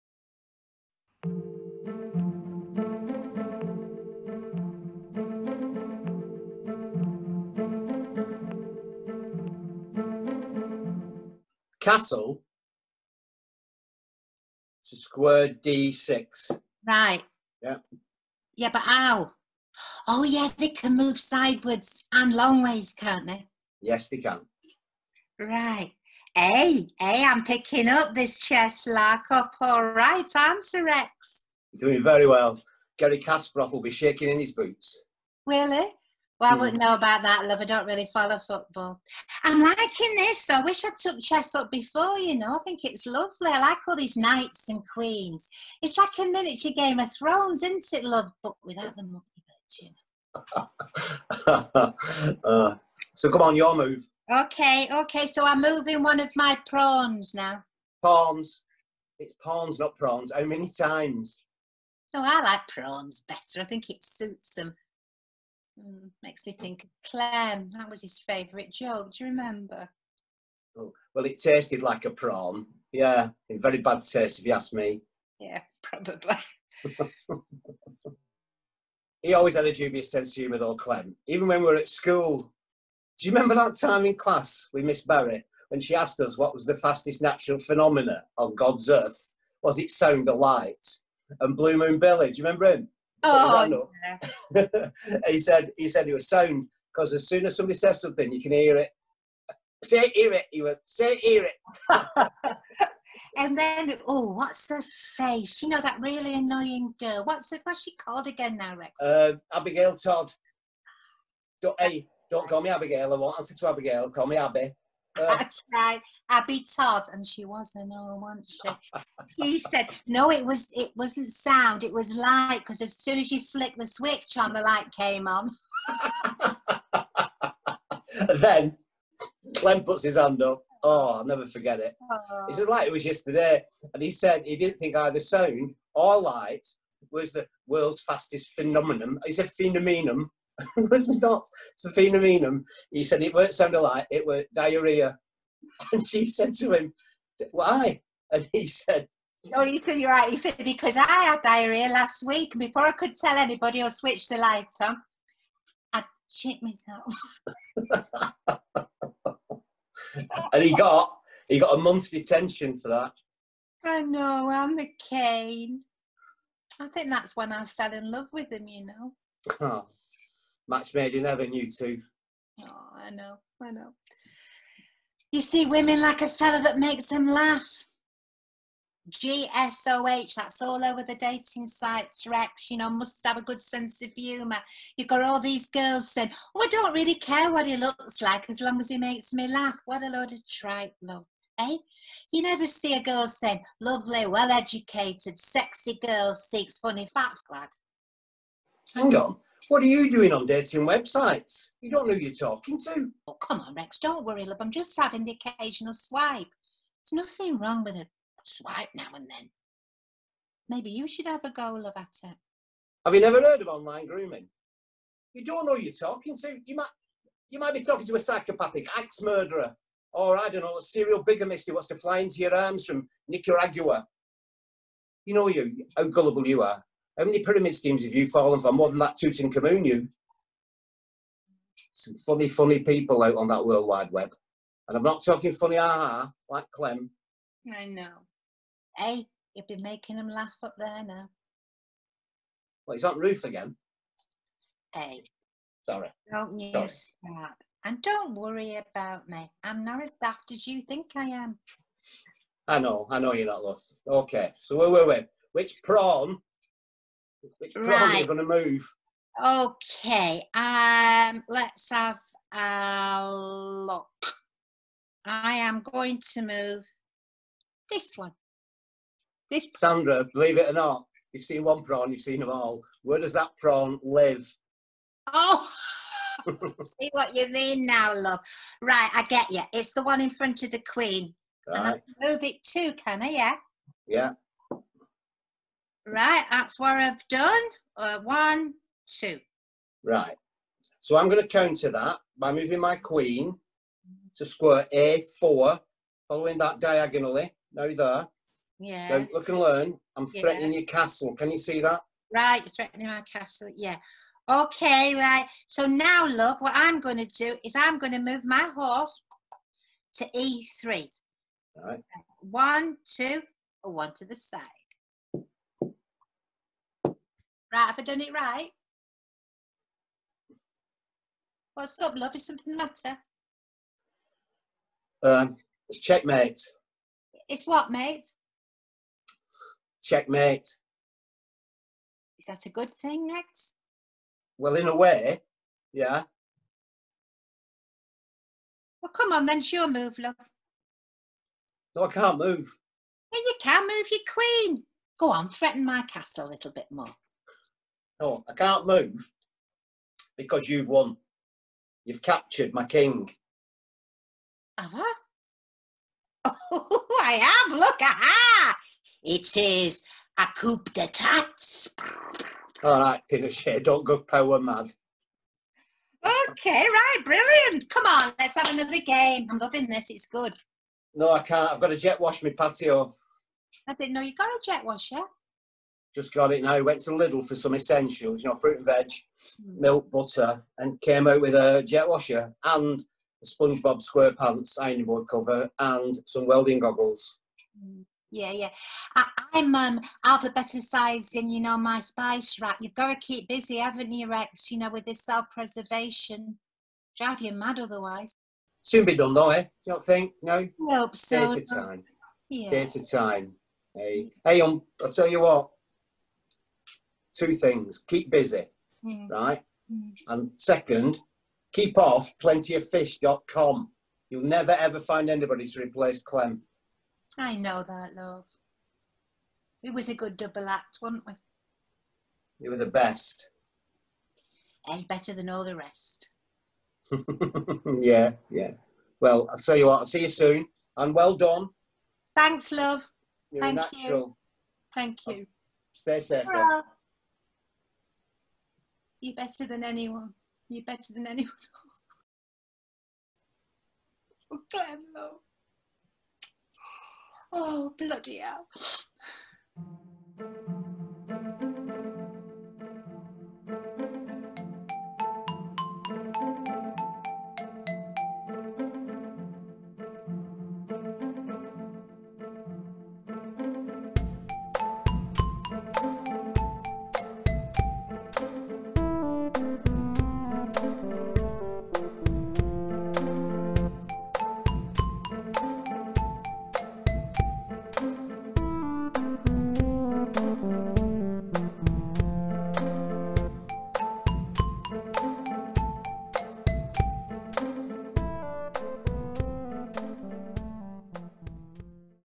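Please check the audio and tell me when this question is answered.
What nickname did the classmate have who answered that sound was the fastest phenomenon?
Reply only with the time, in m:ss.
1:31.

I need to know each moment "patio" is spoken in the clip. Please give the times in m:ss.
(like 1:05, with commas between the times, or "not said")
6:12.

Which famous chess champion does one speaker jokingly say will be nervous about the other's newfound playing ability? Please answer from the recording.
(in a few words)
Garry Kasparov.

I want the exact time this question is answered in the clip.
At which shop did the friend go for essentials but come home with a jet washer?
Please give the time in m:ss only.
6:17.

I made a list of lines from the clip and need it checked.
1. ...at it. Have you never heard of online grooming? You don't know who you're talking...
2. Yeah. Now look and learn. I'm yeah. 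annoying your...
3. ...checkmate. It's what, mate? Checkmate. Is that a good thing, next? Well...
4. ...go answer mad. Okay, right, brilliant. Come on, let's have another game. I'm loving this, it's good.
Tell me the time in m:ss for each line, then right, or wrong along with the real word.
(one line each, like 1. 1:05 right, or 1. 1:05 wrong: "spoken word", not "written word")
1. 3:31 right
2. 4:58 wrong: "threatening", not "annoying"
3. 5:25 right
4. 6:04 wrong: "power", not "answer".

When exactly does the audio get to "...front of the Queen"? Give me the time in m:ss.
4:40.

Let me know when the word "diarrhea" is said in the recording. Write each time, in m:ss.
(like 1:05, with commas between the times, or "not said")
2:24, 2:31.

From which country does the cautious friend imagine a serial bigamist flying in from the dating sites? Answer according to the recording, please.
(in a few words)
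Nicaragua.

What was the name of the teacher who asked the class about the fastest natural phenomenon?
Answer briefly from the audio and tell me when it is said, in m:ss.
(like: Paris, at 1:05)
Miss Barry, at 1:24.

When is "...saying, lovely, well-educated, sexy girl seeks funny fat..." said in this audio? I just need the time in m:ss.
3:13.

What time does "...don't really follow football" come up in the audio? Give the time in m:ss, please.
0:37.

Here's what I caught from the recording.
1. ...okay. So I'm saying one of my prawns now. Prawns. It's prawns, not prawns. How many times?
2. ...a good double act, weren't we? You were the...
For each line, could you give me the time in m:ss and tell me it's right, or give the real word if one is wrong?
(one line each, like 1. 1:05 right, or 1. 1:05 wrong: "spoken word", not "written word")
1. 0:54 wrong: "moving", not "saying"
2. 7:00 right.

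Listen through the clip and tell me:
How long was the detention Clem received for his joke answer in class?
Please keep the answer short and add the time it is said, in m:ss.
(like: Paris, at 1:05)
A month, at 2:41.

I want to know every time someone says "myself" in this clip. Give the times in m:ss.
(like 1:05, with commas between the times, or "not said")
2:36.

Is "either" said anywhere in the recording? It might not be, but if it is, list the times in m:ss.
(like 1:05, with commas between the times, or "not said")
2:14.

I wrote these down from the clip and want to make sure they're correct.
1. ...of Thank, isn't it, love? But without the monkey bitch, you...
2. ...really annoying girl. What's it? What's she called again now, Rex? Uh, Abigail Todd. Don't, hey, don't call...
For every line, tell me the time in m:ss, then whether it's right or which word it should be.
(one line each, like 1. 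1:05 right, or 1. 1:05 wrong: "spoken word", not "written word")
1. 0:46 wrong: "Thrones", not "Thank"
2. 1:45 right.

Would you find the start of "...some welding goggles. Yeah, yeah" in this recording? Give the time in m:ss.
6:26.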